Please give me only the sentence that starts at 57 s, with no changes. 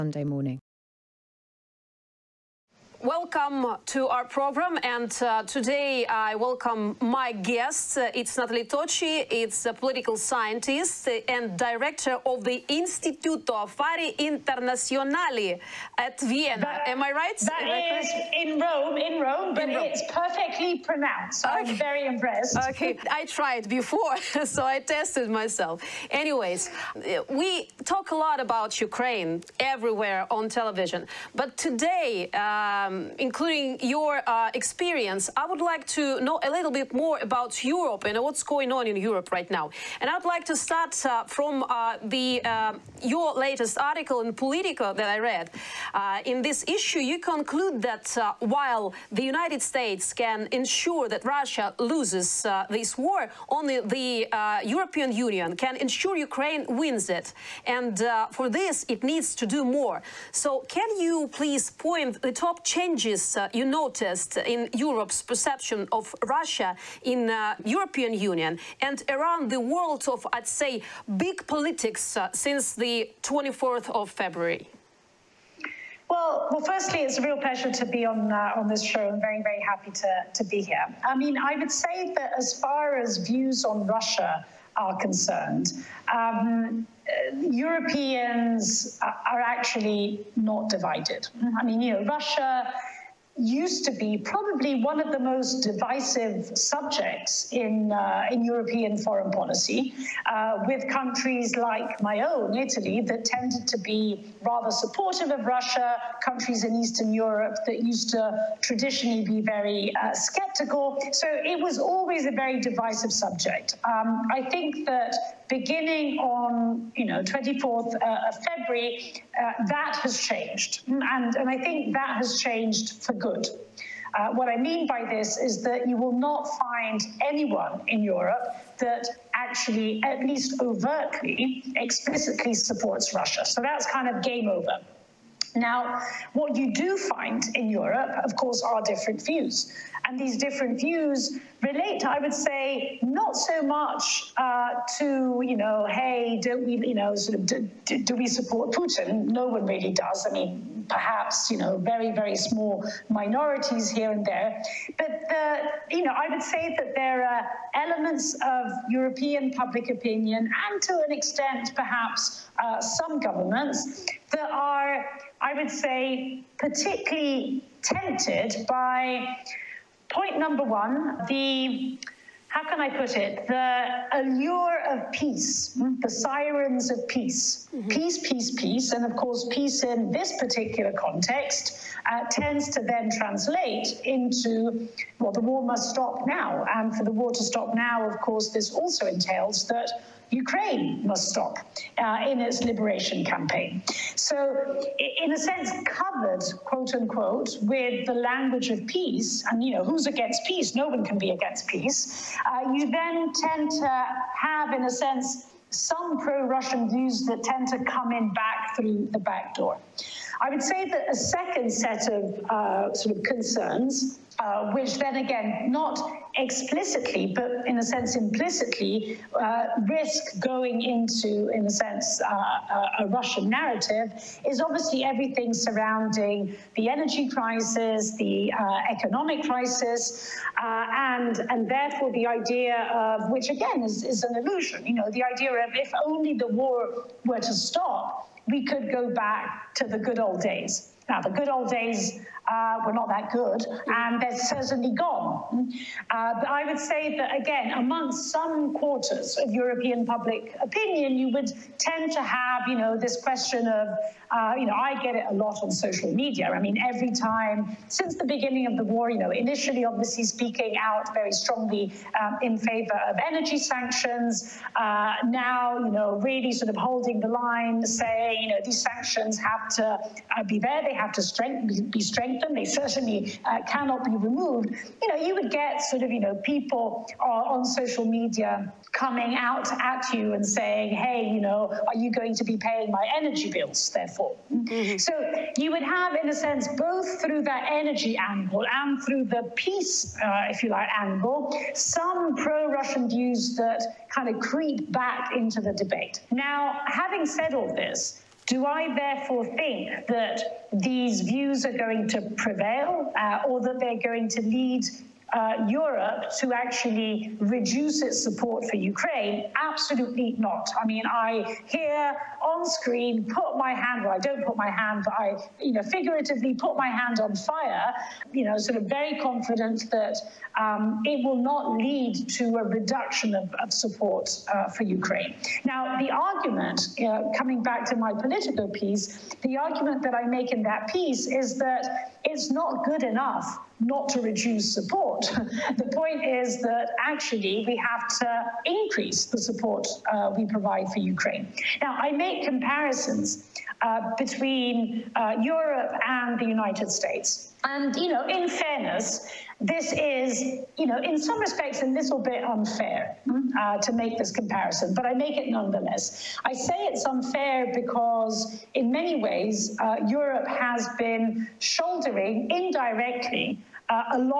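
And for this, it needs to do more.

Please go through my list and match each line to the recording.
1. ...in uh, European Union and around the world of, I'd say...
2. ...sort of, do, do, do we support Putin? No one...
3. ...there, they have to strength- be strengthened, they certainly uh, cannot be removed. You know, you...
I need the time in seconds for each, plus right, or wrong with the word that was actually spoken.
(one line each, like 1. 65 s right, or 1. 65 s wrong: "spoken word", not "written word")
1. 67 s right
2. 147 s right
3. 270 s right.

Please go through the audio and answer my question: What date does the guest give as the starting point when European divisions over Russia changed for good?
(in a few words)
24th of February.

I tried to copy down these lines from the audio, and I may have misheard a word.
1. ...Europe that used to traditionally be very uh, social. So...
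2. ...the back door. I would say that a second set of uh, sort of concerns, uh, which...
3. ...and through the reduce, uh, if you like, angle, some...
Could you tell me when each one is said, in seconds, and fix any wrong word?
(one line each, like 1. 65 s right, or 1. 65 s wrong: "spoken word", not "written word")
1. 107 s wrong: "skeptical", not "social"
2. 209 s right
3. 288 s wrong: "peace", not "reduce".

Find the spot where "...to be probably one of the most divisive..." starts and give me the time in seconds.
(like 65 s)
93 s.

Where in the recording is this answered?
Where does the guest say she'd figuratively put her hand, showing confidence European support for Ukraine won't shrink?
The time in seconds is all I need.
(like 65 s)
317 s.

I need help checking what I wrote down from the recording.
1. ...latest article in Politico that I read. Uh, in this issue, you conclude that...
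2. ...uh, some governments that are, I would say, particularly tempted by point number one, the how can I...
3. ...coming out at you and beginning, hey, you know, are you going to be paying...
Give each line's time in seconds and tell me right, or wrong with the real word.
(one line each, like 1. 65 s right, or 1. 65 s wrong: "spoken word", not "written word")
1. 43 s right
2. 162 s right
3. 278 s wrong: "saying", not "beginning".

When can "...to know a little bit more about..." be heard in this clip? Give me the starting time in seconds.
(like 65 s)
35 s.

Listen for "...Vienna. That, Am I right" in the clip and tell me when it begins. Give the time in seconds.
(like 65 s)
16 s.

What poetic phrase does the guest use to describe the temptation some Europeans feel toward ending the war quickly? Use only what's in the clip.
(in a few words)
the sirens of peace.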